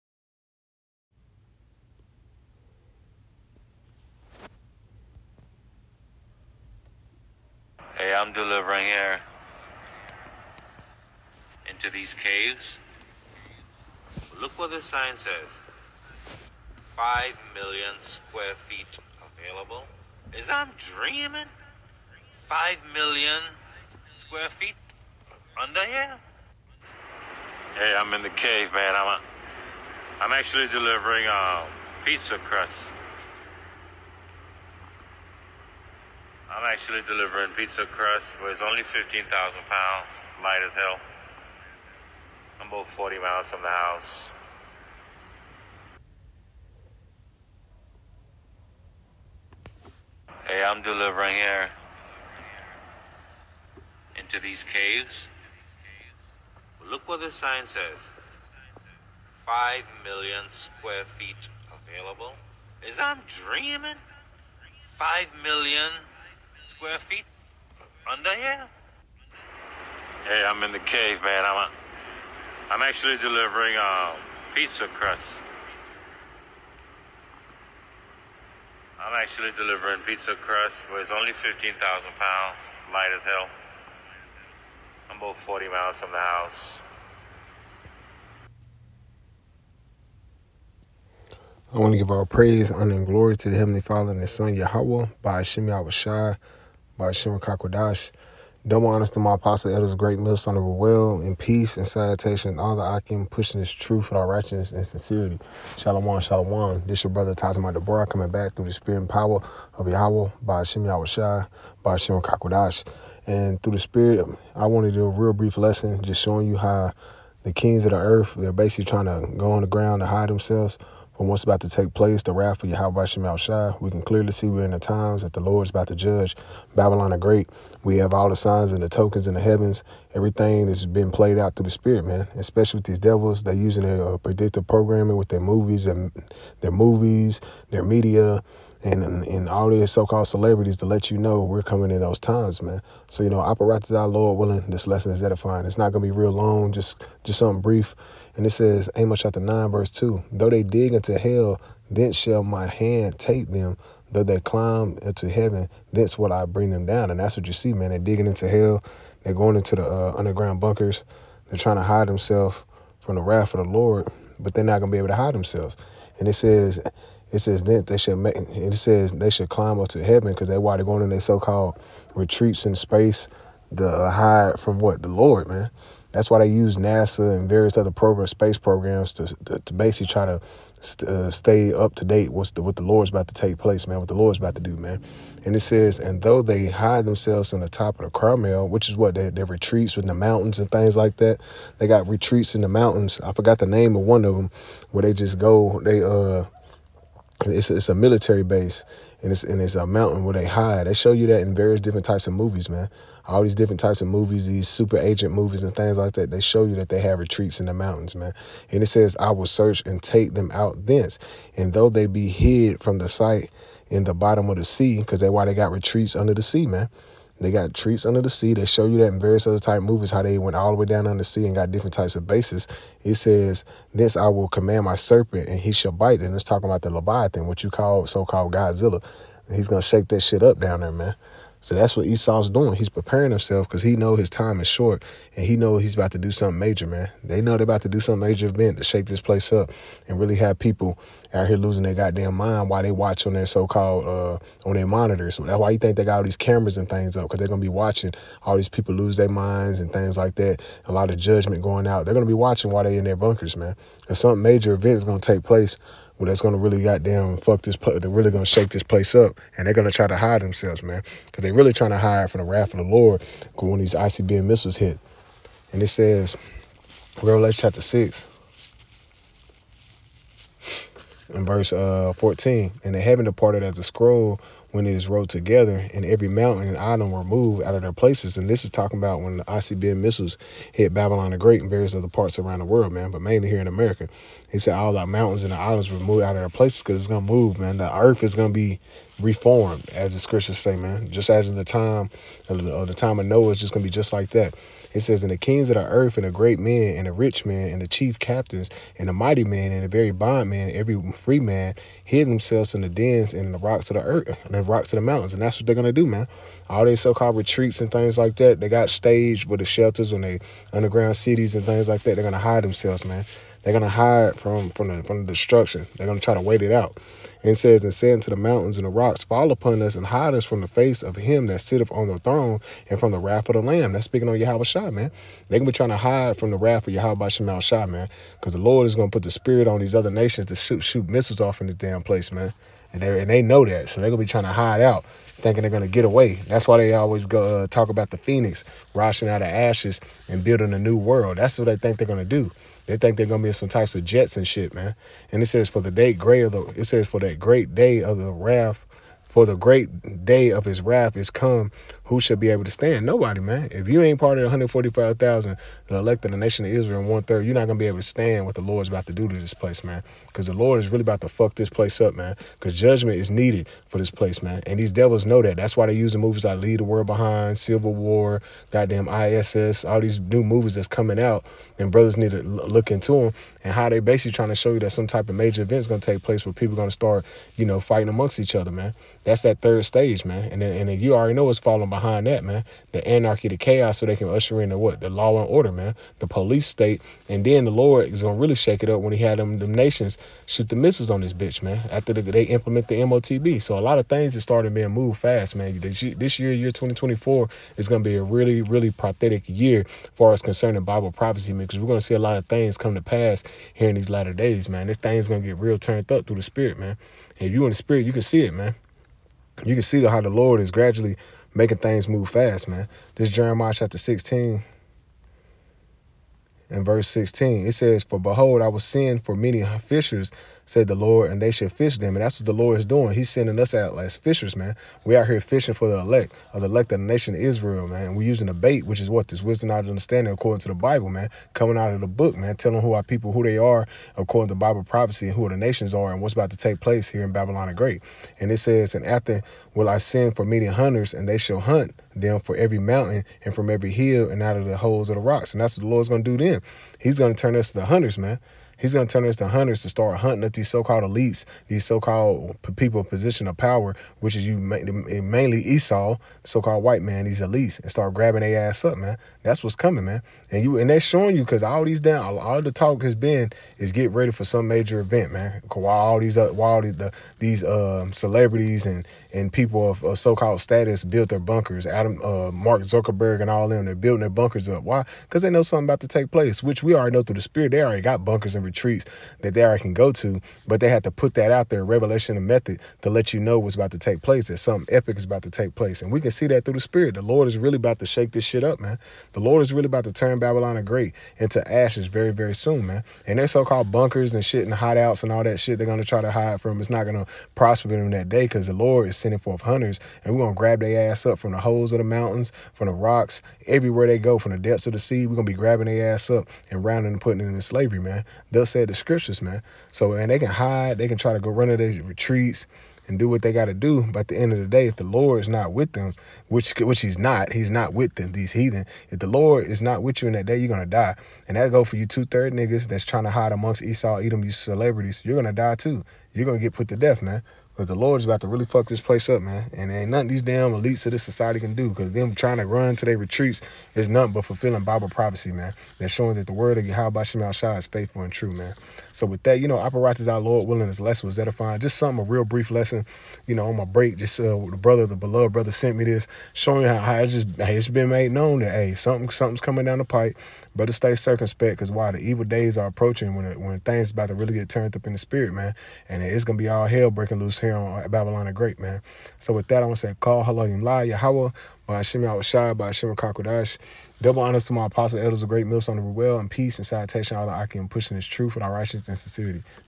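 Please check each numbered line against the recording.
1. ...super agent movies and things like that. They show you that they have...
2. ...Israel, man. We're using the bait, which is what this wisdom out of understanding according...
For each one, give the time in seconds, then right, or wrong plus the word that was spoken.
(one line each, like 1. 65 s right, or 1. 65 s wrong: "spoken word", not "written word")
1. 204 s right
2. 427 s right.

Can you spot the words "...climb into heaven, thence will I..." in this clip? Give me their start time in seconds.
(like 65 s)
154 s.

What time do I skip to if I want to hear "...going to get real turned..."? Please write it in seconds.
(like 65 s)
405 s.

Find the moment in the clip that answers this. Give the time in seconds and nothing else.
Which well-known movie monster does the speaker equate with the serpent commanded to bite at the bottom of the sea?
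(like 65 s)
228 s.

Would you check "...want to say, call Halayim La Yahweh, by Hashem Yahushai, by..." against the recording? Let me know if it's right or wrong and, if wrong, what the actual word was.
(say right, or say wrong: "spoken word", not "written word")
right.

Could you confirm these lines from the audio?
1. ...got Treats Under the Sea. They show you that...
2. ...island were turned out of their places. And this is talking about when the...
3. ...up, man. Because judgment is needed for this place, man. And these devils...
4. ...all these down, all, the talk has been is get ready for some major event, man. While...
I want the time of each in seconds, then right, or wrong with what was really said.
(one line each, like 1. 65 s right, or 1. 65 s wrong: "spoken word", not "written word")
1. 217 s right
2. 276 s wrong: "moved", not "turned"
3. 362 s right
4. 461 s right.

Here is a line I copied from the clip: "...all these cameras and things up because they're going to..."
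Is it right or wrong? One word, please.
right.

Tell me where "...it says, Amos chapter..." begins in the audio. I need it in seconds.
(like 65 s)
148 s.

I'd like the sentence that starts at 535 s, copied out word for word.
They're showing that the word of Yahweh Shah is faithful and true, man.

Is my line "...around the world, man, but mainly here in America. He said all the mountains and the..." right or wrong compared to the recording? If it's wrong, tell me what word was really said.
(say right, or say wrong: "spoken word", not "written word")
right.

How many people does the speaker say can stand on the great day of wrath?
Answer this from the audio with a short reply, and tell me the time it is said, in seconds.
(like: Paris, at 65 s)
145,000, at 354 s.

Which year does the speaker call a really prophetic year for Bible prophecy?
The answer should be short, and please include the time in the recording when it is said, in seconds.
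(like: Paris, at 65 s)
2024, at 396 s.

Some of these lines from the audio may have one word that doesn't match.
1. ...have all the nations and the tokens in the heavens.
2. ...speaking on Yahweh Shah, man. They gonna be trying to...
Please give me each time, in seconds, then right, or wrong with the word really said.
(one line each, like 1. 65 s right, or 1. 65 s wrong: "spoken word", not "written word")
1. 127 s wrong: "signs", not "nations"
2. 324 s right.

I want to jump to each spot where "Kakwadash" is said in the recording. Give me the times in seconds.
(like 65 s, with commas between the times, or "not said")
97 s, 112 s.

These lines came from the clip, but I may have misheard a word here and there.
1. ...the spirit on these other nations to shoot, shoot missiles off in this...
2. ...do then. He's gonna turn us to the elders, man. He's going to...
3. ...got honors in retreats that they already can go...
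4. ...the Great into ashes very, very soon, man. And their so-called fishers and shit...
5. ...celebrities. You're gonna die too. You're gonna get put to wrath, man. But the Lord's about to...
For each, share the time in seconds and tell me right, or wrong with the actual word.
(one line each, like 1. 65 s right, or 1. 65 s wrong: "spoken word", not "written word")
1. 329 s right
2. 446 s wrong: "hunters", not "elders"
3. 478 s wrong: "bunkers", not "honors"
4. 490 s wrong: "bunkers", not "fishers"
5. 524 s wrong: "death", not "wrath".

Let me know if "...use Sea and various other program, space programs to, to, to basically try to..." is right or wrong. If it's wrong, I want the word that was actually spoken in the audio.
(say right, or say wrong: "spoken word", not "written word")
wrong: "NASA", not "Sea".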